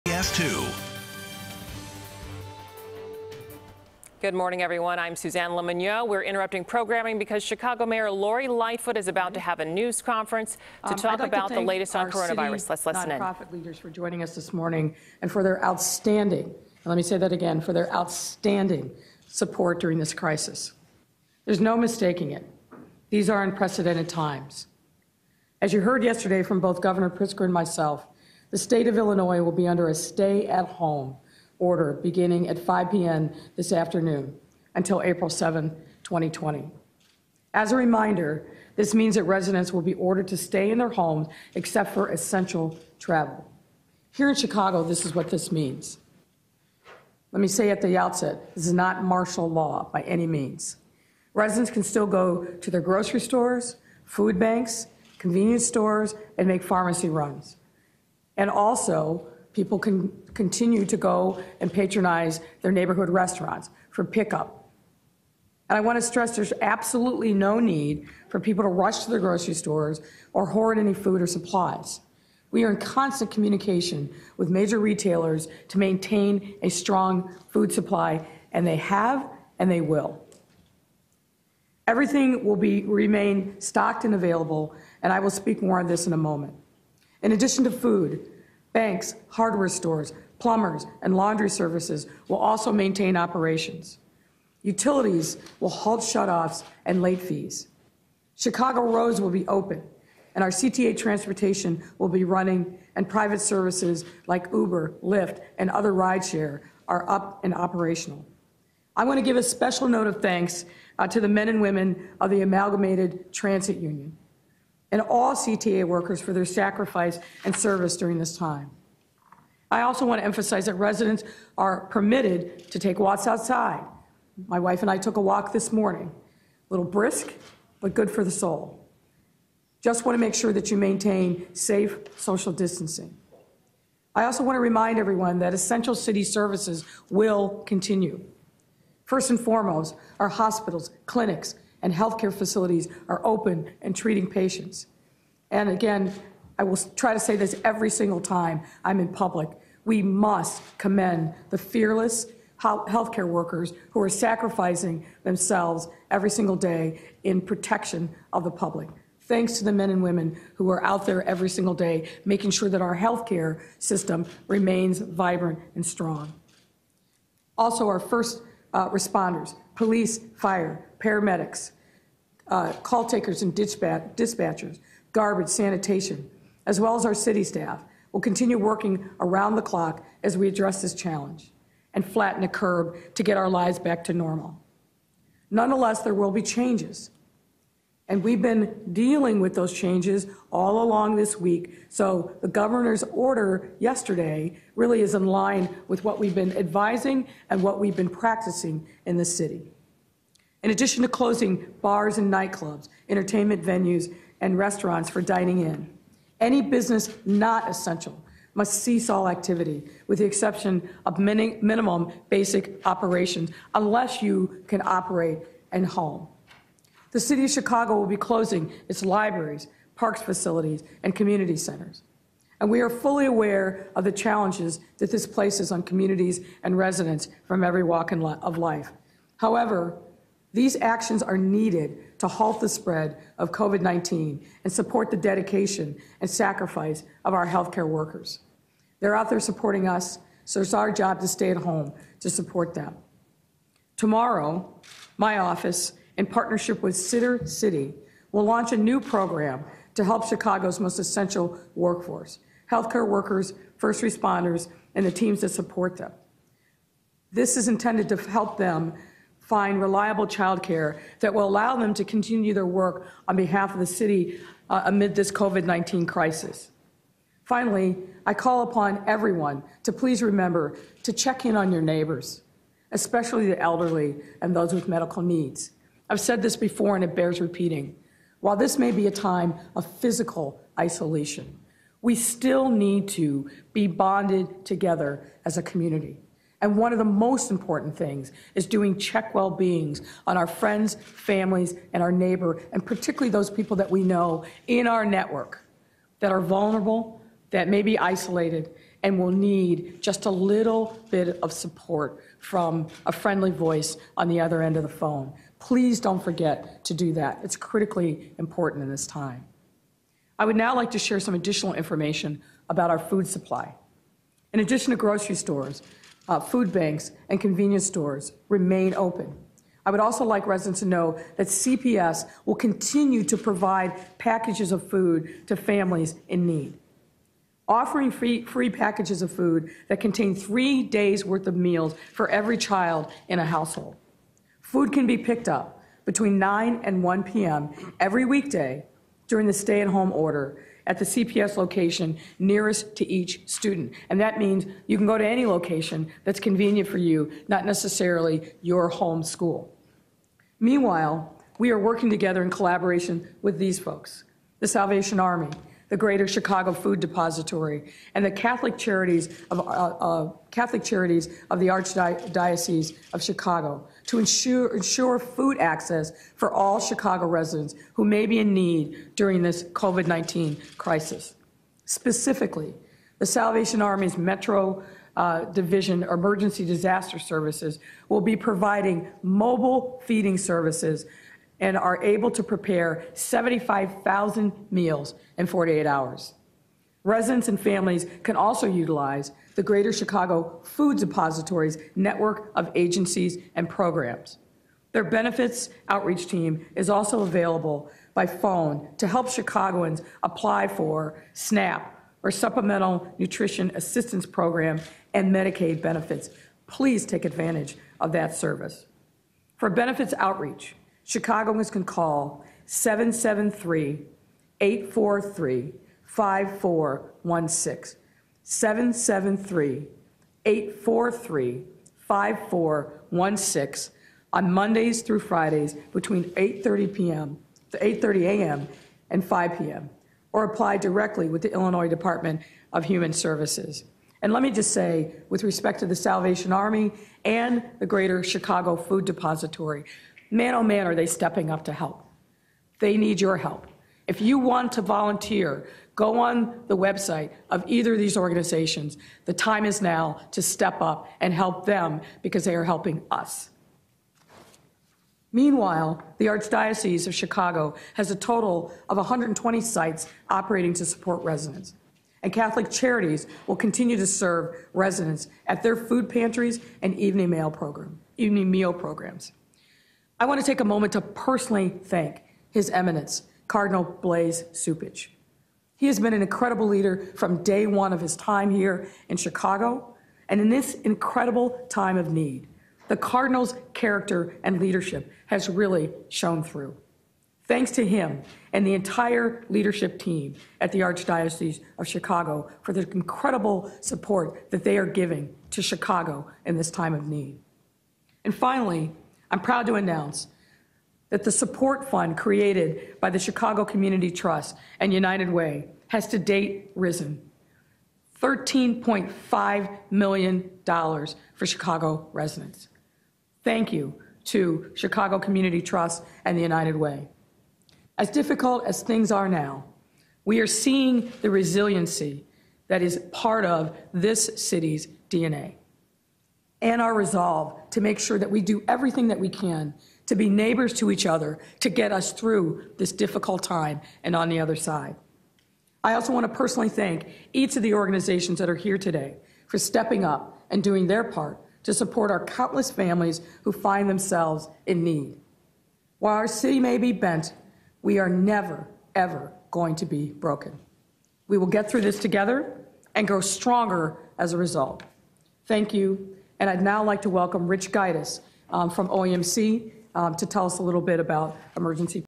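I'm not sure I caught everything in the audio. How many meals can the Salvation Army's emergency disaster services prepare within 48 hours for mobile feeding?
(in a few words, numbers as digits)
75,000.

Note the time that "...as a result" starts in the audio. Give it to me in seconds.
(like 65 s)
554 s.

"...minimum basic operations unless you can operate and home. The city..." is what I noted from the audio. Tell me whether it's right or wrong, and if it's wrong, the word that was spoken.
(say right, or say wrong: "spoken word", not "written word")
right.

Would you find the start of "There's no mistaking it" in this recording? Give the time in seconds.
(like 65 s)
21 s.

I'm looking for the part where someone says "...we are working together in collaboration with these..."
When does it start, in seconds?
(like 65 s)
351 s.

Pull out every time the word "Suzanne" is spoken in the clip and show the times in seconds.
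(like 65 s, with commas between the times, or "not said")
5 s.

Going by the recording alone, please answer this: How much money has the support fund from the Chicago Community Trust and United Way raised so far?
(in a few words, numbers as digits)
$13.5 million.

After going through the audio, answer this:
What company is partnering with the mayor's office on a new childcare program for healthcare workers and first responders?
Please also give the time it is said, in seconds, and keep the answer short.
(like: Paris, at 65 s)
Sittercity, at 246 s.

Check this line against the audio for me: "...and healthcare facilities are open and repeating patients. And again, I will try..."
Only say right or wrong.
wrong.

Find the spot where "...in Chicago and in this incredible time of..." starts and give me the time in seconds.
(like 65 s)
479 s.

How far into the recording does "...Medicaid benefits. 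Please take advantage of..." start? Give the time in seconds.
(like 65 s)
405 s.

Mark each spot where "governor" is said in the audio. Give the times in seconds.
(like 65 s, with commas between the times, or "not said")
26 s, 192 s.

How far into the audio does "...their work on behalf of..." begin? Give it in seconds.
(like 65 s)
262 s.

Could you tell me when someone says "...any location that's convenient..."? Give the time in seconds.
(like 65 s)
345 s.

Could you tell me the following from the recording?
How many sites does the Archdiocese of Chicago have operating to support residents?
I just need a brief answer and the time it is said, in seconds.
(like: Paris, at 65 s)
120, at 458 s.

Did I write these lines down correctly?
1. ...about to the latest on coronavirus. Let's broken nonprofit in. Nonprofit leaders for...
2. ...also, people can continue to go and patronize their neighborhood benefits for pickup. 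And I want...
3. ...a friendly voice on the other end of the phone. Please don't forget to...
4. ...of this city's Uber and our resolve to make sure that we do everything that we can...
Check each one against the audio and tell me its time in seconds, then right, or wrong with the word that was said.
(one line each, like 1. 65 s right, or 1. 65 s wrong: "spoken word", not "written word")
1. 11 s wrong: "listen", not "broken"
2. 58 s wrong: "restaurants", not "benefits"
3. 303 s right
4. 523 s wrong: "DNA", not "Uber".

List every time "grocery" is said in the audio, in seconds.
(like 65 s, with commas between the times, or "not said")
52 s, 69 s, 314 s.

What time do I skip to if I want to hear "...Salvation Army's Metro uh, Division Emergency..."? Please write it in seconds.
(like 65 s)
373 s.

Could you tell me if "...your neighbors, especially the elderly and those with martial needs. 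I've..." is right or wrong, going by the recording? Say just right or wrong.
wrong.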